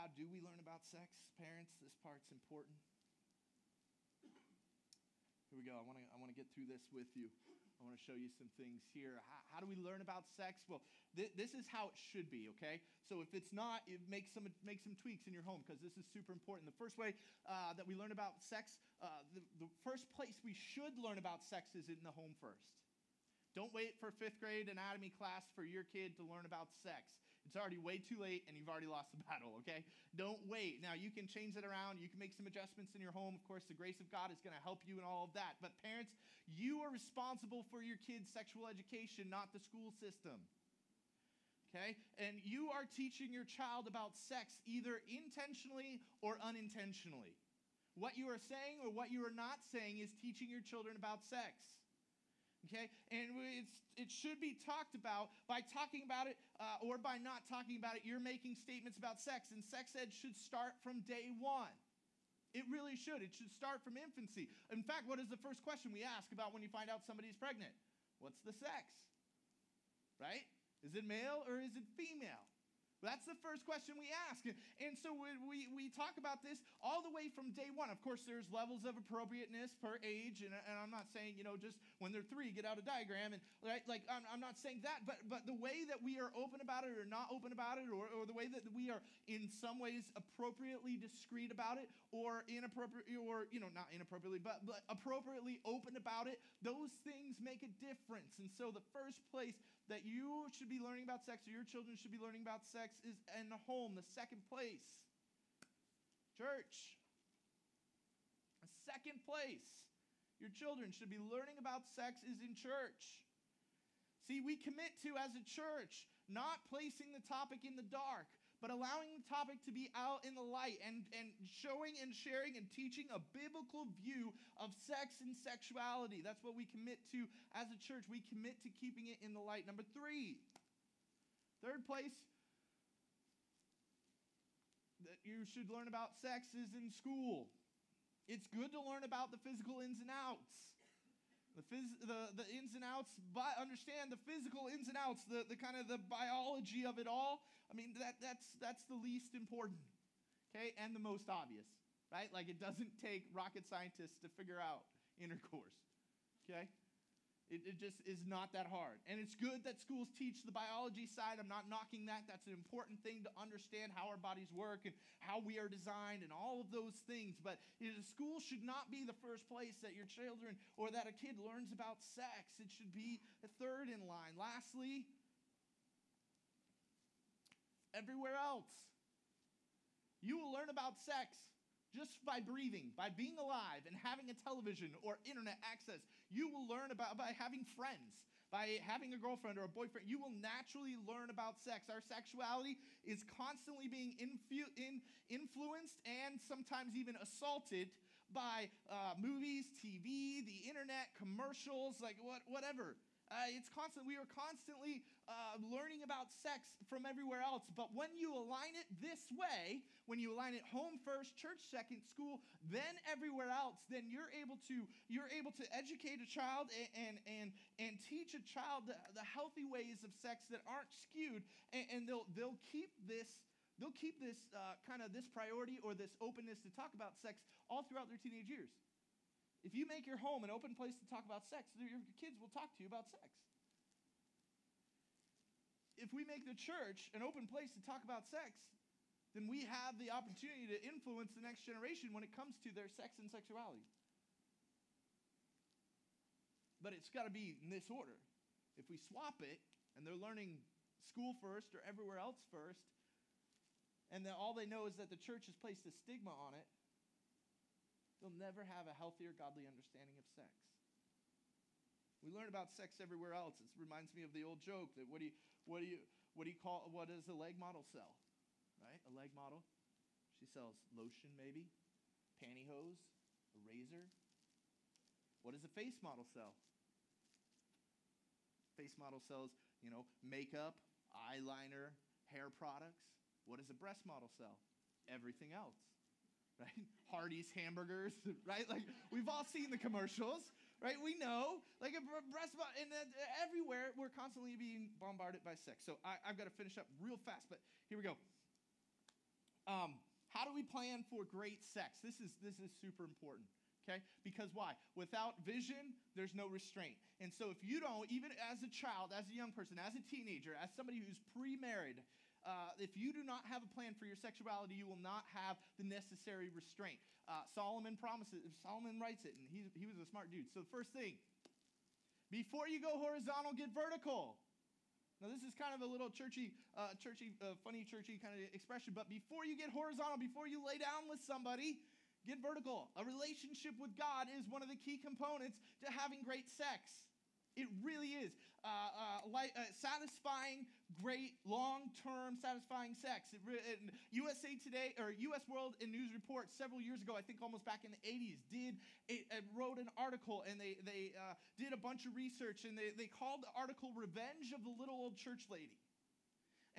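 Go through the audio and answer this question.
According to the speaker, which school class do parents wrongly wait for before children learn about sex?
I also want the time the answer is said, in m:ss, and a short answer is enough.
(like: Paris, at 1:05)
fifth grade anatomy class, at 0:24.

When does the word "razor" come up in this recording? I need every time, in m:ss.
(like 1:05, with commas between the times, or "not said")
4:33.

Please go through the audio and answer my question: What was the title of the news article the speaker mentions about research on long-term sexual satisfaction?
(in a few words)
Revenge of the Little Old Church Lady.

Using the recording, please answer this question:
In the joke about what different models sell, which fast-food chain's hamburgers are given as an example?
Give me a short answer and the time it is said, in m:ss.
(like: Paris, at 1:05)
Hardee's, at 4:47.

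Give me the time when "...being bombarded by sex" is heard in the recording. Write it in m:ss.
4:54.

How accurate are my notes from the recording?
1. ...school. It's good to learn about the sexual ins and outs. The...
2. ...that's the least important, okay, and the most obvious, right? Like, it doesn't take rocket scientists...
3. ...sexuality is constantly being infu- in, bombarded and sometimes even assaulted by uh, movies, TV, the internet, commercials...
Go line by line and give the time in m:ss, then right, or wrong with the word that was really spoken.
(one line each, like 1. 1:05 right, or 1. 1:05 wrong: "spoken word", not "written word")
1. 2:16 wrong: "physical", not "sexual"
2. 2:28 right
3. 3:11 wrong: "influenced", not "bombarded".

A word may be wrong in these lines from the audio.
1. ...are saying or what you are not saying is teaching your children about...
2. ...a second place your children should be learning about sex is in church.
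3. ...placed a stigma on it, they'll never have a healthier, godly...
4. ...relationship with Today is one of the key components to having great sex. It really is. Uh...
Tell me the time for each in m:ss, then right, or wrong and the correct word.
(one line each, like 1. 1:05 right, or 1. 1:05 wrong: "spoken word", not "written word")
1. 0:48 right
2. 1:48 right
3. 4:15 right
4. 5:33 wrong: "God", not "Today".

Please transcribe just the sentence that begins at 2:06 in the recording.
That's what we commit to as a church.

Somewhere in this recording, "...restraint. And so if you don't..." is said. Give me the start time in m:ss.
5:06.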